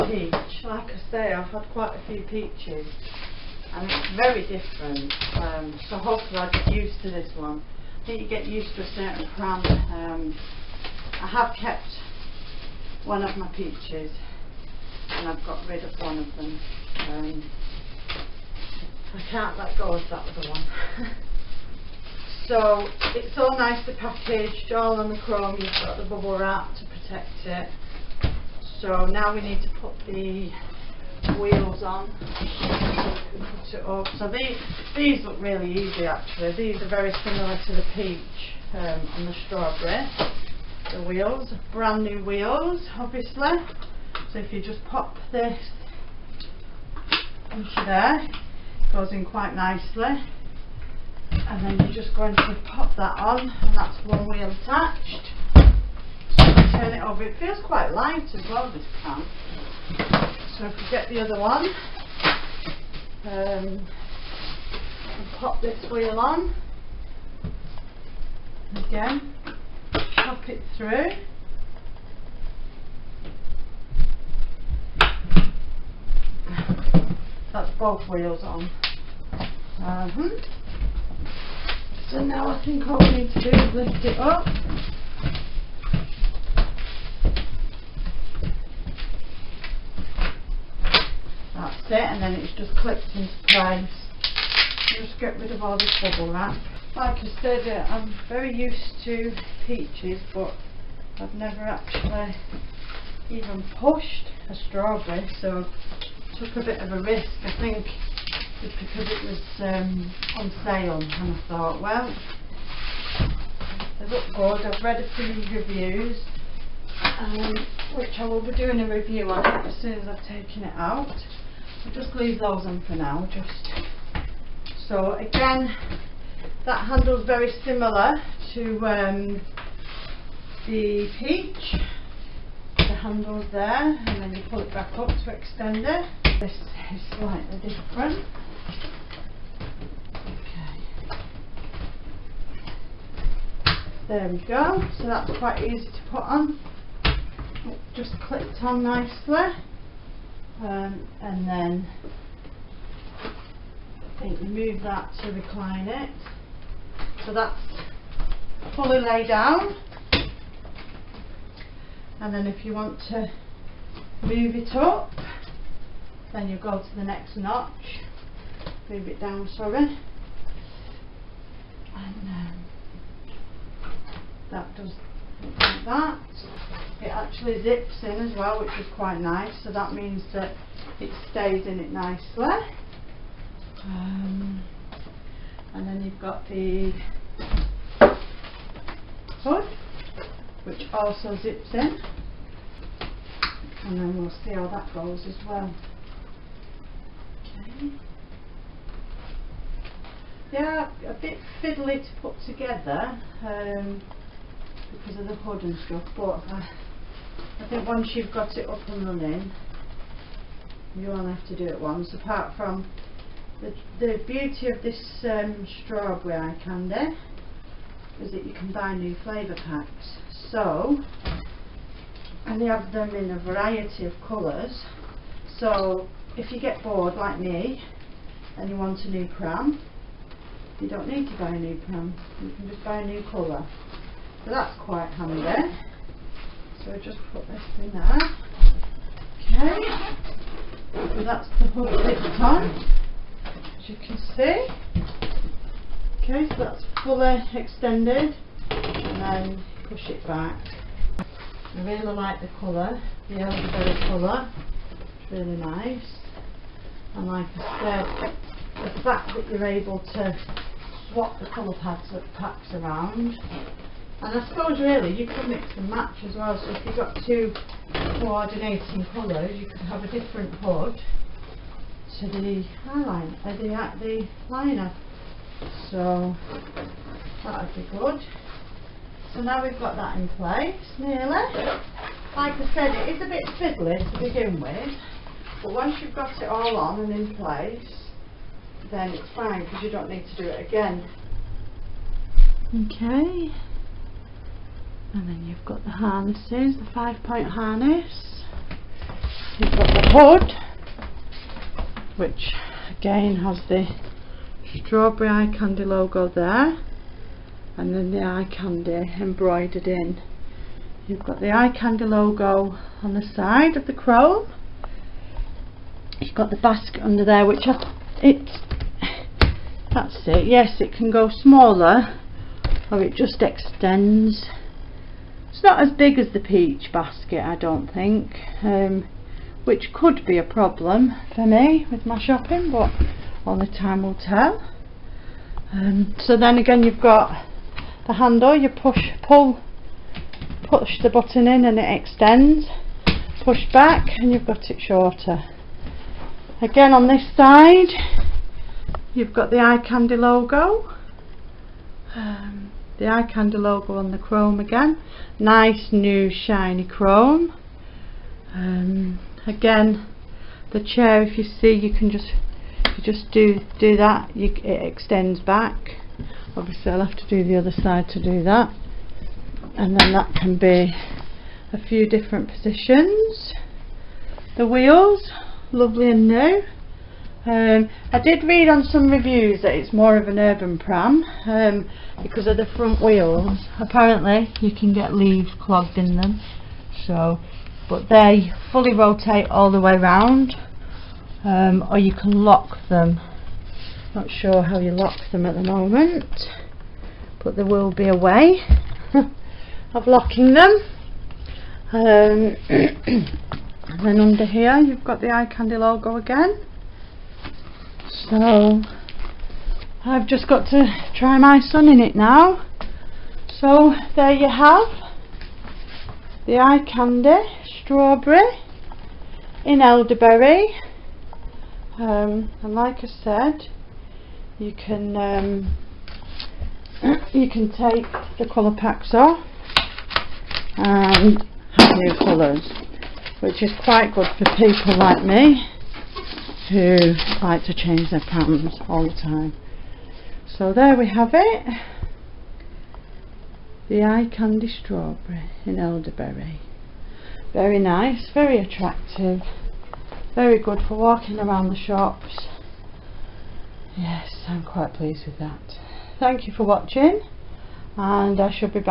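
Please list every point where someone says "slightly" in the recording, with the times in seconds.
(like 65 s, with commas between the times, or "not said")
137 s.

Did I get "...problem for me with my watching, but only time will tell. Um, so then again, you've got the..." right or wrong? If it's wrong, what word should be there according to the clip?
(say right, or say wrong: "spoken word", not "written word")
wrong: "shopping", not "watching".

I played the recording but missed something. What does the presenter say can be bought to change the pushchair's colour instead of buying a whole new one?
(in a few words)
Flavour packs.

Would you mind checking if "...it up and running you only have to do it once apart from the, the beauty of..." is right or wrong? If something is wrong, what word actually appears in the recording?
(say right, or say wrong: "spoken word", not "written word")
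right.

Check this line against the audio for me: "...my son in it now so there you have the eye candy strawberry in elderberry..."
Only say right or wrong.
right.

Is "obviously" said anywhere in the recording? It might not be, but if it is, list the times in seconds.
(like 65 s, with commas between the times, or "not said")
42 s, 366 s.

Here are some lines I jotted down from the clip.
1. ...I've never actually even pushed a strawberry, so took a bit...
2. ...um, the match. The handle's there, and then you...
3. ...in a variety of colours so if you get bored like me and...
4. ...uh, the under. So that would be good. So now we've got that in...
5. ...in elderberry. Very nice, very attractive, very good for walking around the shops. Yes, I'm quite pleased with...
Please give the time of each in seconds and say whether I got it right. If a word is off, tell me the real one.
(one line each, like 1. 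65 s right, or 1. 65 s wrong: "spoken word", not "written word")
1. 101 s right
2. 128 s wrong: "peach", not "match"
3. 223 s right
4. 273 s wrong: "liner", not "under"
5. 445 s right.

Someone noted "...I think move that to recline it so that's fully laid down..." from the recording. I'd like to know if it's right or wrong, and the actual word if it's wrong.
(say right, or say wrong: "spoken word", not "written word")
right.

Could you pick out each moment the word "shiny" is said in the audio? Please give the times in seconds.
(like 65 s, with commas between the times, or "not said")
356 s.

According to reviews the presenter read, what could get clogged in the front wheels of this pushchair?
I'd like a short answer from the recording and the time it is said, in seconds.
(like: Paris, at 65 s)
Leaves, at 385 s.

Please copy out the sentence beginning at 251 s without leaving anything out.
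I really like the colour, the elderberry colour.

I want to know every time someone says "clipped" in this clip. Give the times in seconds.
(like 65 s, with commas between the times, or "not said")
92 s, 148 s.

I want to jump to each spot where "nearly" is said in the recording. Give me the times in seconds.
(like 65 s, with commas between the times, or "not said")
280 s.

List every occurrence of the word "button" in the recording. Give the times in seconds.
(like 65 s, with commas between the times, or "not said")
341 s.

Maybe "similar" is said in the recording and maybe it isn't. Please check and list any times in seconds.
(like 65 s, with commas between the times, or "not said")
37 s, 127 s.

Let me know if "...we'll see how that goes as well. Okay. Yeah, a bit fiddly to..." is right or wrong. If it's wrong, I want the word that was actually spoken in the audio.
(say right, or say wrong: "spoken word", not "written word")
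right.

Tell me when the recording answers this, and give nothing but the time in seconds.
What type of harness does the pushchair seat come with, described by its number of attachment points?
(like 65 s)
296 s.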